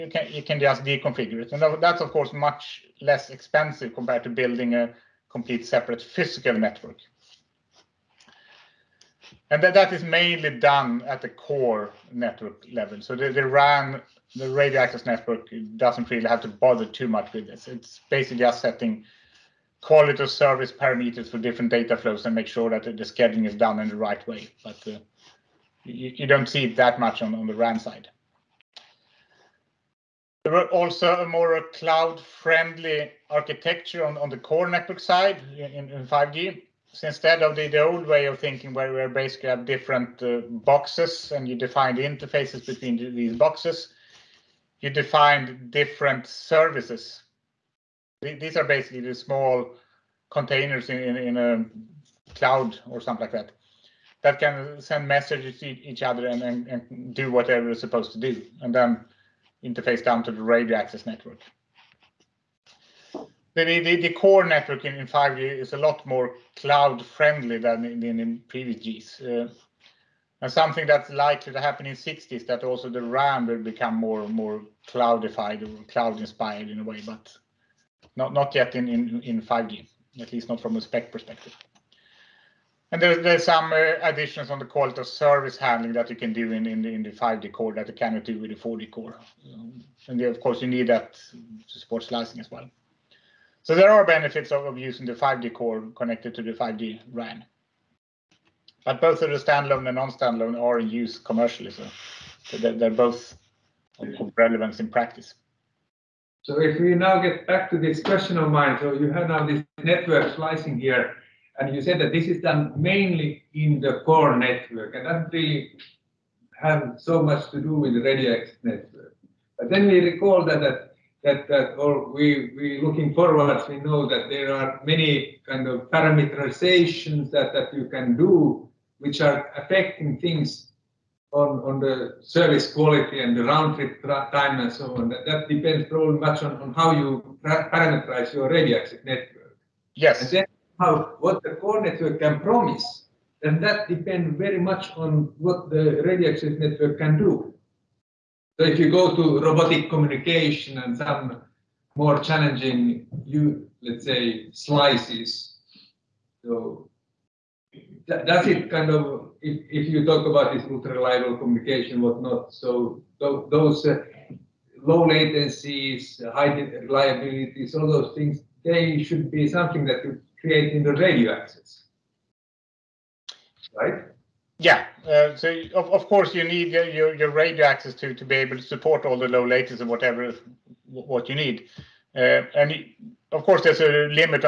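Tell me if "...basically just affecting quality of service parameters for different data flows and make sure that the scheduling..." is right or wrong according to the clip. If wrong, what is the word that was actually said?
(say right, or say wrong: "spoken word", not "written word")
wrong: "setting", not "affecting".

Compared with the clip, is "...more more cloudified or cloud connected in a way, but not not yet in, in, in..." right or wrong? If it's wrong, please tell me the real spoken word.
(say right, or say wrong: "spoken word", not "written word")
wrong: "inspired", not "connected".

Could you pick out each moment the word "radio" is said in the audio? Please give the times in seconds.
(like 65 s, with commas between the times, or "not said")
14 s, 60 s, 118 s, 138 s, 146 s, 170 s, 177 s.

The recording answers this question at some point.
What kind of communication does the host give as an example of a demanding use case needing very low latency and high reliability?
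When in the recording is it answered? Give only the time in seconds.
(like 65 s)
149 s.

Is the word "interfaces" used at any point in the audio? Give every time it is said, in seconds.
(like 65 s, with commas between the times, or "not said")
42 s, 59 s.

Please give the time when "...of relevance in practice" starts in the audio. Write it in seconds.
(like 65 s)
103 s.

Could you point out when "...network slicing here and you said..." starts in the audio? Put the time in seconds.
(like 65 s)
109 s.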